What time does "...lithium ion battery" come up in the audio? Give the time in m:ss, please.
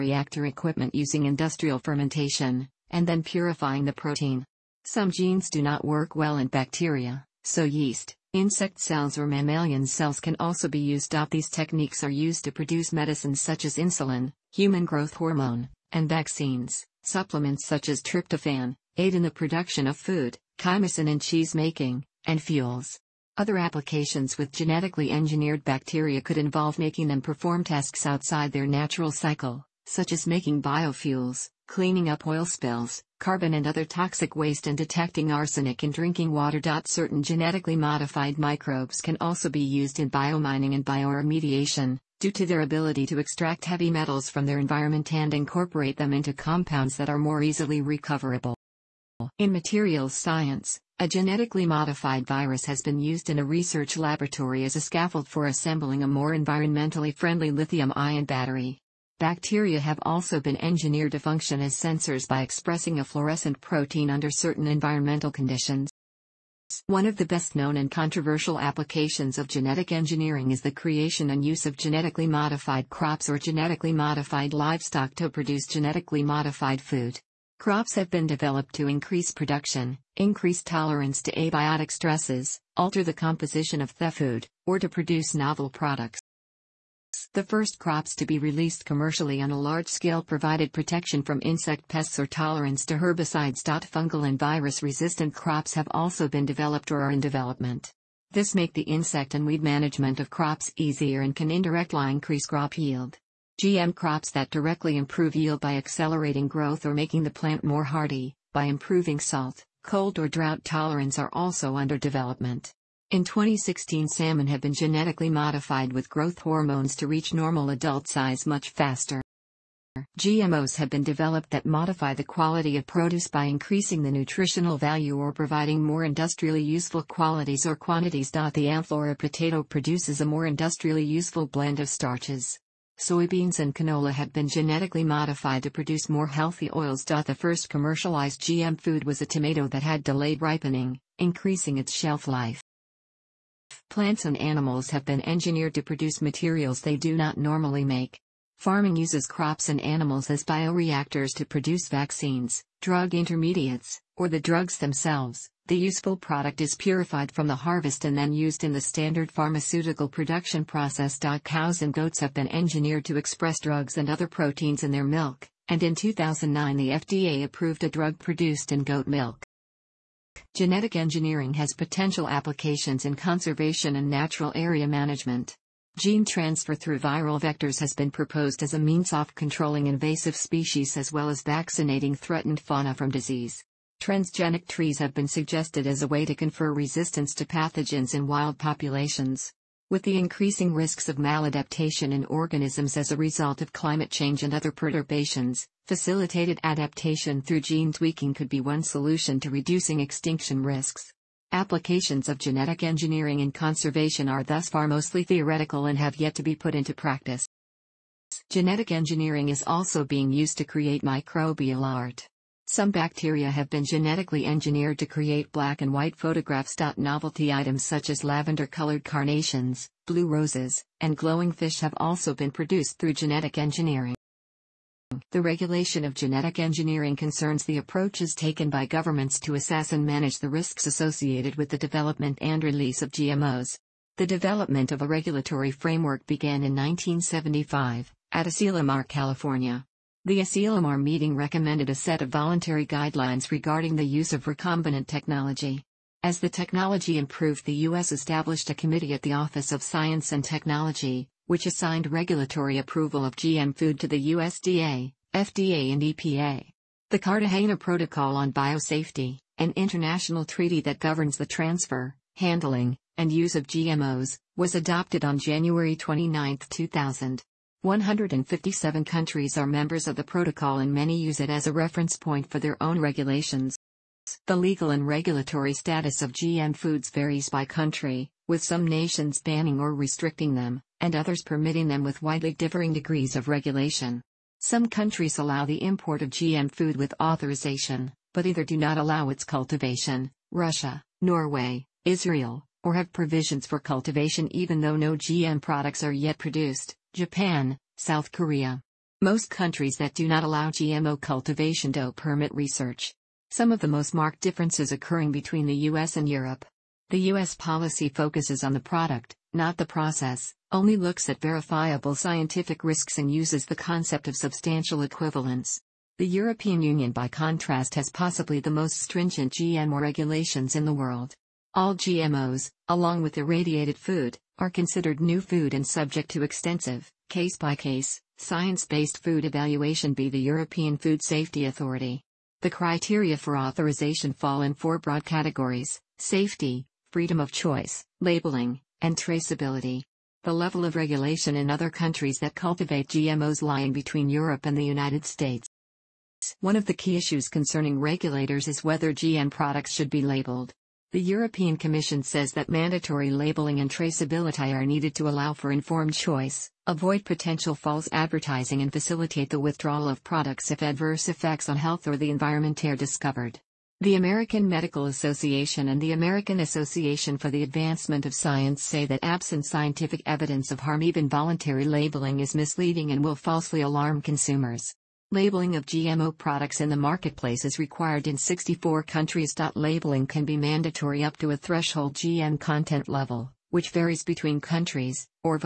0:57.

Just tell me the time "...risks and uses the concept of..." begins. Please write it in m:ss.
5:12.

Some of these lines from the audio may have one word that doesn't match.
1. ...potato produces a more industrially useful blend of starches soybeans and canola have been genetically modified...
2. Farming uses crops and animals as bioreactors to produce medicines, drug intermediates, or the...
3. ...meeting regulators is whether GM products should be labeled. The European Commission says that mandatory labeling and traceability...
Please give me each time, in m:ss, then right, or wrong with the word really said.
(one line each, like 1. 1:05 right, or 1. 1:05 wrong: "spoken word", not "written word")
1. 2:09 right
2. 2:28 wrong: "vaccines", not "medicines"
3. 5:47 wrong: "concerning", not "meeting".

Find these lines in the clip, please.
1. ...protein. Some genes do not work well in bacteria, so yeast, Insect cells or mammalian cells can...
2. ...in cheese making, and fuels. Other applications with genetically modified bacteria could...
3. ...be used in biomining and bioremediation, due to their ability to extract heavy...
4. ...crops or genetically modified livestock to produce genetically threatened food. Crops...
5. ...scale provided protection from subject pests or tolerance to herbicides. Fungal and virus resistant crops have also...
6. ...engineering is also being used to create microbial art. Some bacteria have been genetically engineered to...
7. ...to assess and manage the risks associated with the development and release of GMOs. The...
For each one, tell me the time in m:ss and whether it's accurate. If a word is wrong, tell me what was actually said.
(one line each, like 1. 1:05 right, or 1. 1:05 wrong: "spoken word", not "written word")
1. 0:03 right
2. 0:21 wrong: "engineered", not "modified"
3. 0:39 right
4. 1:12 wrong: "modified", not "threatened"
5. 1:29 wrong: "insect", not "subject"
6. 3:28 right
7. 3:49 right.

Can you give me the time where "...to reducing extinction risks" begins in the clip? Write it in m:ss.
3:19.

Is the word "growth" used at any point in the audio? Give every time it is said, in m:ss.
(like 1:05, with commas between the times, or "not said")
0:14, 1:46, 1:56.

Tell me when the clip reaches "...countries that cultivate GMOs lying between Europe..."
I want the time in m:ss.
5:41.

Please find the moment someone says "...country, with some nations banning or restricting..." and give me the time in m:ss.
4:37.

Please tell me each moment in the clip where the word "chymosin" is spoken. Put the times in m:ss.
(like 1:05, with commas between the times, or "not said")
0:20.